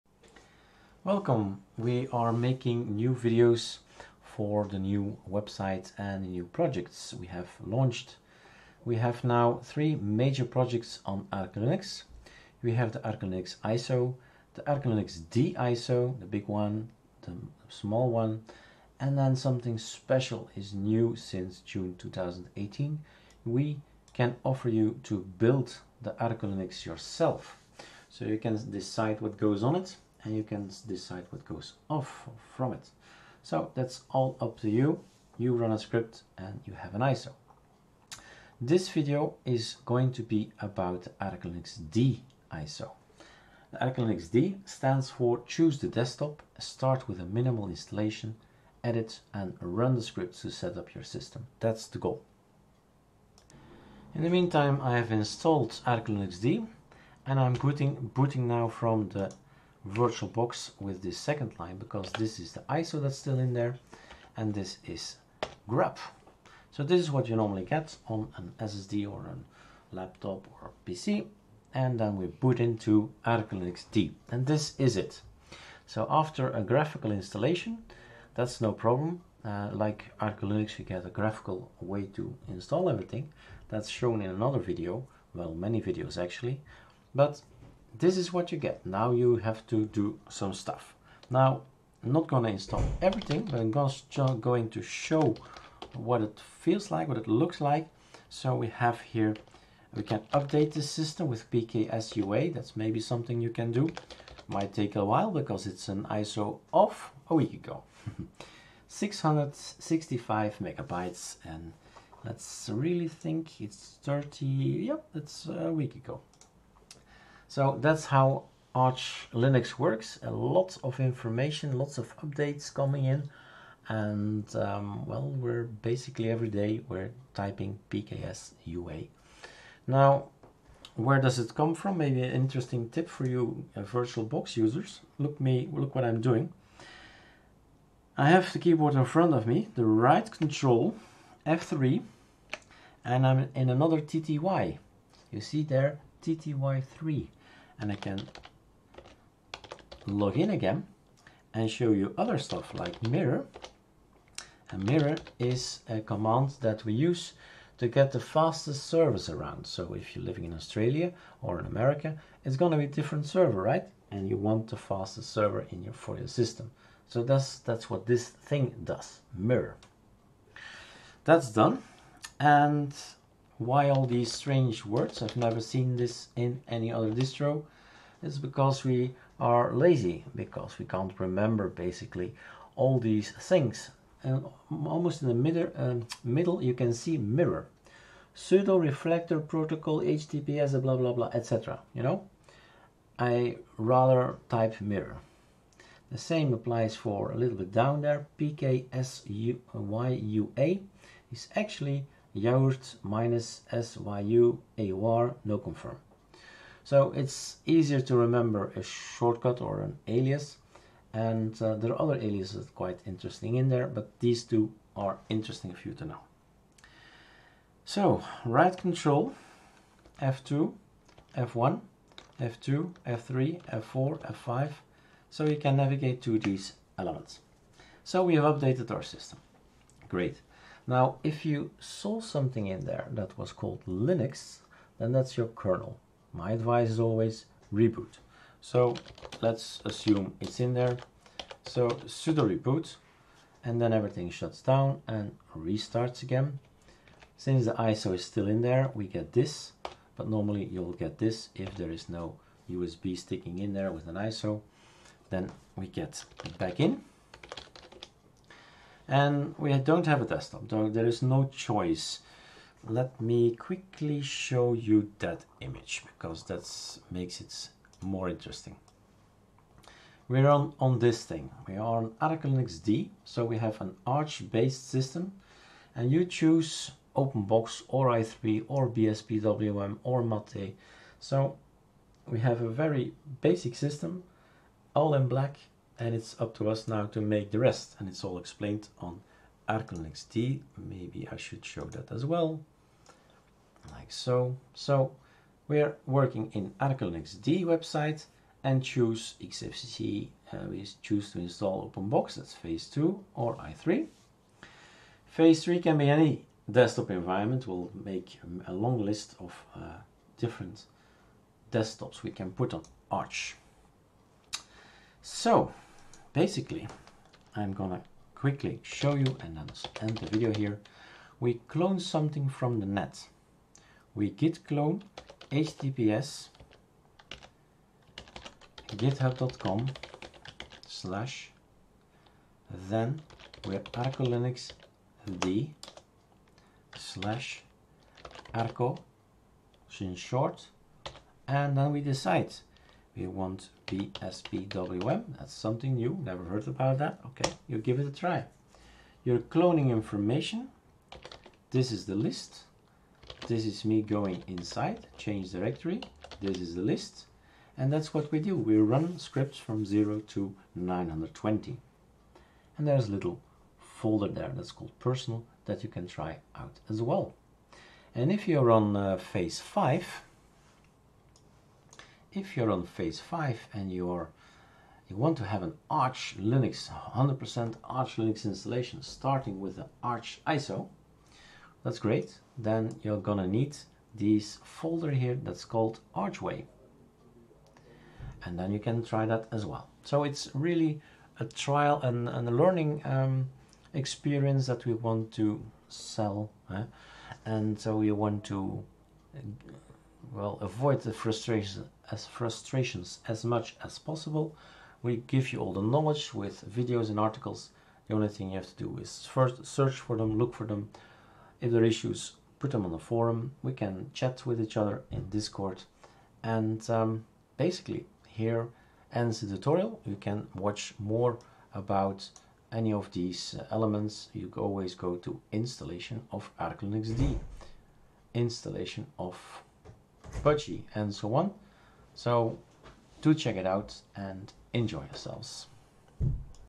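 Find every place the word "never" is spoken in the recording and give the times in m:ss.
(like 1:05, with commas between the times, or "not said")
2:55, 5:46.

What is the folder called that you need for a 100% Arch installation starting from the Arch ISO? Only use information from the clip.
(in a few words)
Archway.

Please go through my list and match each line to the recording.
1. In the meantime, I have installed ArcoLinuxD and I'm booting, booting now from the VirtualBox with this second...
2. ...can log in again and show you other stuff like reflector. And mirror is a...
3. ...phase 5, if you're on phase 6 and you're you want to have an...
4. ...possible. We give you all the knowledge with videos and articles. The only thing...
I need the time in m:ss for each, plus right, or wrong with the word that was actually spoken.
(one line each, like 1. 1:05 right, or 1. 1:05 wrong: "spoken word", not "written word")
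1. 0:54 right
2. 2:27 wrong: "mirror", not "reflector"
3. 6:09 wrong: "5", not "6"
4. 6:43 right.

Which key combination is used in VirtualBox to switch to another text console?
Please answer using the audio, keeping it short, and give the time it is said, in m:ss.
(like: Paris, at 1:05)
right control, F3, at 2:19.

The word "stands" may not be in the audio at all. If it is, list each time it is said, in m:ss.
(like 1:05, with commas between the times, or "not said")
0:44.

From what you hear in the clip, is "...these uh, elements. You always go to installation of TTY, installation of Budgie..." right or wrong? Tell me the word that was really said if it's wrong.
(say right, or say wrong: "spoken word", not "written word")
wrong: "ArcoLinuxD", not "TTY".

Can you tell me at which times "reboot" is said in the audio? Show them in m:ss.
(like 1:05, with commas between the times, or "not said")
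3:57, 4:02.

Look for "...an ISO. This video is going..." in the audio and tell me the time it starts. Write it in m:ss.
0:36.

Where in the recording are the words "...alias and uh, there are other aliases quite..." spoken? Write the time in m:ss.
3:30.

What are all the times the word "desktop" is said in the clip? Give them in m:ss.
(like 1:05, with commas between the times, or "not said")
0:45, 4:20, 5:06, 5:11.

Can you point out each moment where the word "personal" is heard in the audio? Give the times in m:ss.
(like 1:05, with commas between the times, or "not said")
6:04.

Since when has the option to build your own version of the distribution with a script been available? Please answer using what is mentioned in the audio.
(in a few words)
June 2018.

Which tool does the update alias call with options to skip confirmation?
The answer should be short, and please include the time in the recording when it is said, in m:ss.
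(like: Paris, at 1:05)
Yaourt, at 3:22.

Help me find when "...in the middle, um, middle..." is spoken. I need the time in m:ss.
3:05.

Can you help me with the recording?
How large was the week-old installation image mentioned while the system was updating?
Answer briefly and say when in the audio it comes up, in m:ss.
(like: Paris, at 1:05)
665 megabytes, at 1:48.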